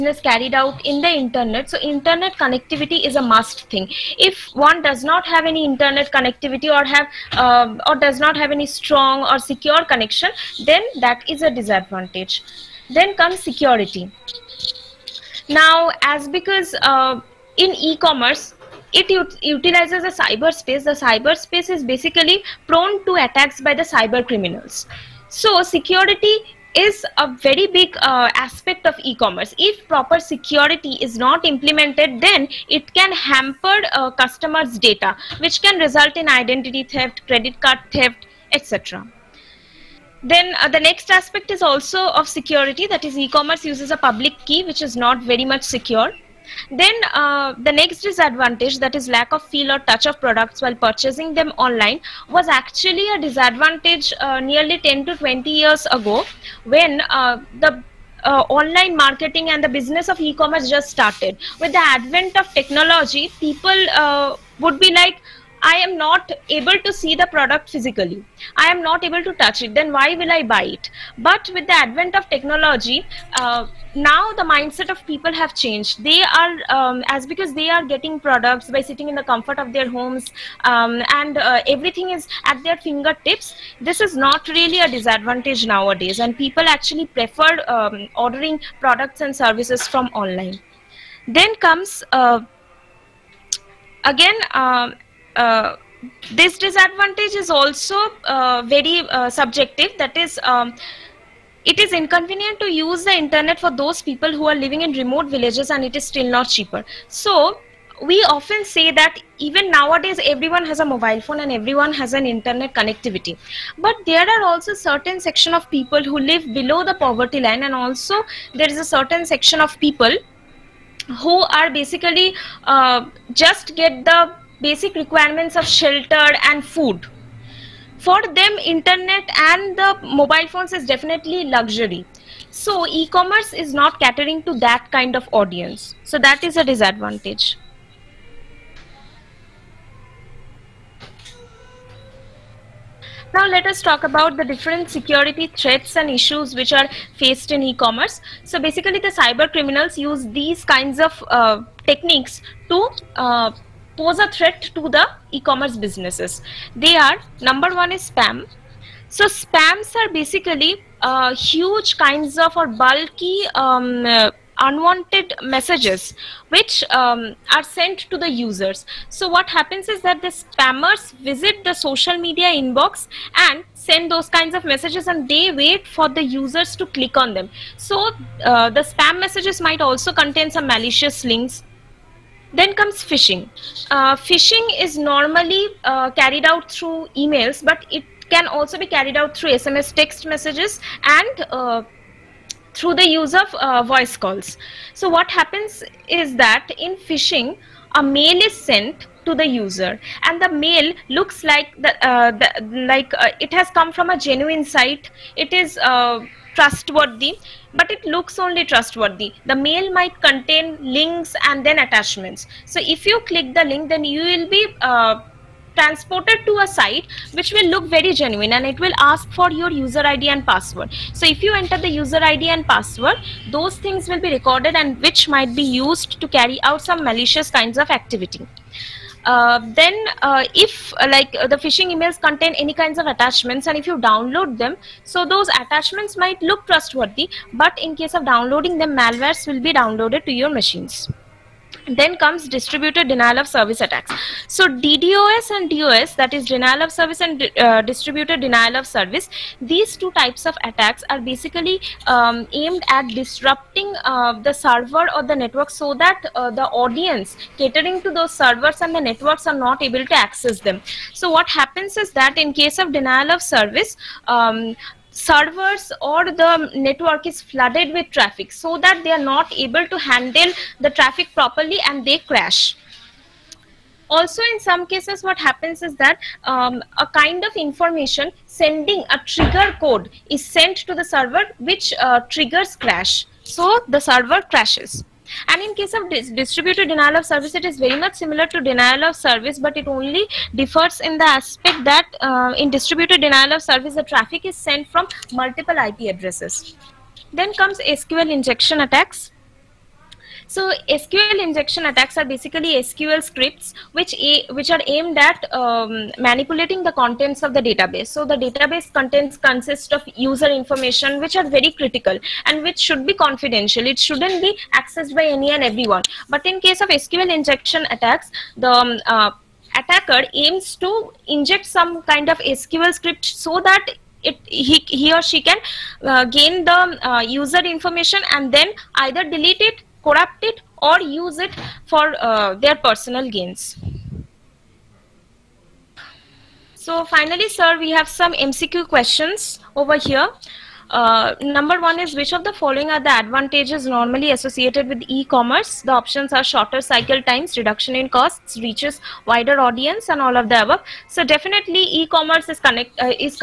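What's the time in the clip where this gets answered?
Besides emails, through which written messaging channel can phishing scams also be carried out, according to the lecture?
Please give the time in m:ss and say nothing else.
3:09.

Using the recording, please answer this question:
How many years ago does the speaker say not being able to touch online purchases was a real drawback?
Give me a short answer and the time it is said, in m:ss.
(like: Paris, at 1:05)
10 to 20 years, at 0:54.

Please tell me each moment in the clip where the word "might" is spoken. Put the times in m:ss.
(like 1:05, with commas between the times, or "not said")
2:59, 3:29, 3:45, 3:56.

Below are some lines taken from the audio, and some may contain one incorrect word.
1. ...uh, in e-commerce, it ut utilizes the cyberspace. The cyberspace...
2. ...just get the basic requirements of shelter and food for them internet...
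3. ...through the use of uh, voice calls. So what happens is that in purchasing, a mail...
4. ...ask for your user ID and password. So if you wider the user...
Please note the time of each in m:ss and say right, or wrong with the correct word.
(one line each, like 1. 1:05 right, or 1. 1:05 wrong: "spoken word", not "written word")
1. 0:16 right
2. 2:03 right
3. 3:12 wrong: "phishing", not "purchasing"
4. 3:38 wrong: "enter", not "wider".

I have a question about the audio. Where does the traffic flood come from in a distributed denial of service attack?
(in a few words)
Multiple IP addresses.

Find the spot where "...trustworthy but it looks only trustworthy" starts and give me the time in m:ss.
3:26.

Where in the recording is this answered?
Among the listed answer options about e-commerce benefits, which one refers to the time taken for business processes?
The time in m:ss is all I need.
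5:46.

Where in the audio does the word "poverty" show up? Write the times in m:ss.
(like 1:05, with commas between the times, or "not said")
1:56.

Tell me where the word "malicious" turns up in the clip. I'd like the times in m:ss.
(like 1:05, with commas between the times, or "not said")
3:00, 3:47.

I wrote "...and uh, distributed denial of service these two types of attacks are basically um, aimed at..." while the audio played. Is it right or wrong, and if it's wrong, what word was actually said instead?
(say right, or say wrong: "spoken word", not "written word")
right.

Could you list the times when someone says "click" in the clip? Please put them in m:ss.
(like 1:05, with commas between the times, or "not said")
2:56, 3:33.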